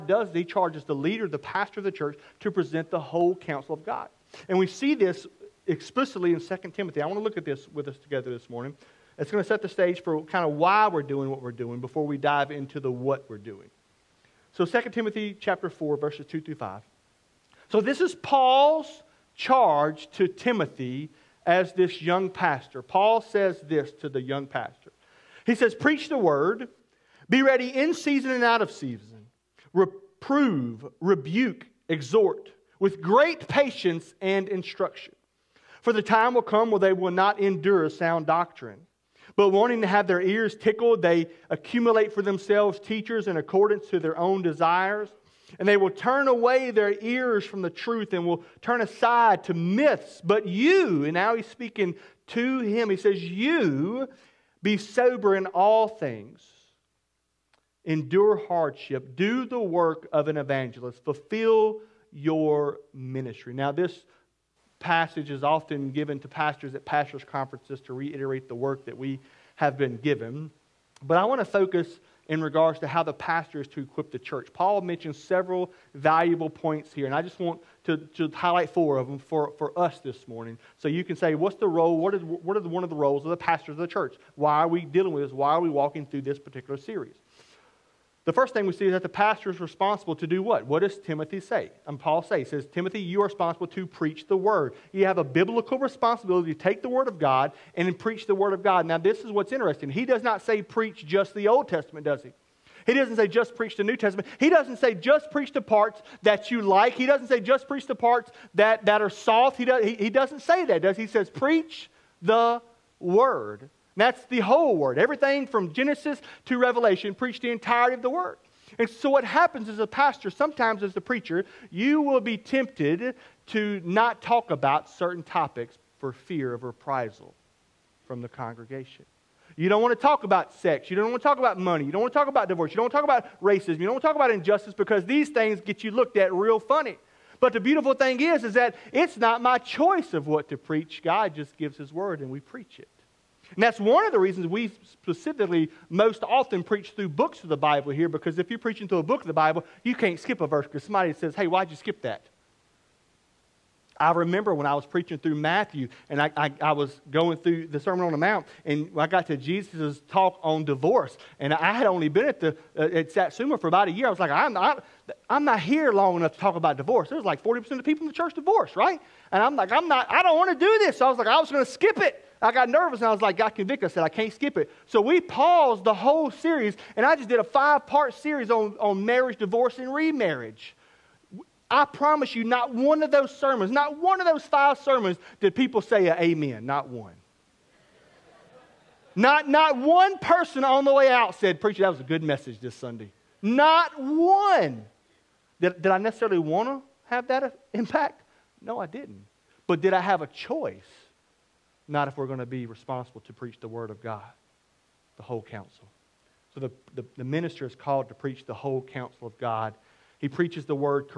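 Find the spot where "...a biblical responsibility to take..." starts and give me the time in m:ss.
1:35.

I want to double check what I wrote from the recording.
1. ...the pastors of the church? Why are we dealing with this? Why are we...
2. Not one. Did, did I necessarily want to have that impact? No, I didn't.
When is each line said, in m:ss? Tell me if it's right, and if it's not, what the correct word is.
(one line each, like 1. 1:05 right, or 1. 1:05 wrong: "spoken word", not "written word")
1. 1:23 right
2. 3:13 right.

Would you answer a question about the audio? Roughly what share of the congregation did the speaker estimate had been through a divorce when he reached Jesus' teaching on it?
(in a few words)
40%.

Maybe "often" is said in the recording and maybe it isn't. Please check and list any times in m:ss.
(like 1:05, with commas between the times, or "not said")
1:05, 2:26.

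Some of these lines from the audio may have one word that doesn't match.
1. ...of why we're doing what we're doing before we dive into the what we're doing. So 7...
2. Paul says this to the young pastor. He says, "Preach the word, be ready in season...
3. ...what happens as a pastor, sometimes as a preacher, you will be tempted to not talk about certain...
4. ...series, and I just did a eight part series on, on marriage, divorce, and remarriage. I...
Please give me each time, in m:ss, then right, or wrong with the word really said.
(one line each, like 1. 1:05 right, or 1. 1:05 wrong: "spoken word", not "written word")
1. 0:10 wrong: "2", not "7"
2. 0:22 right
3. 1:59 right
4. 2:56 wrong: "five", not "eight".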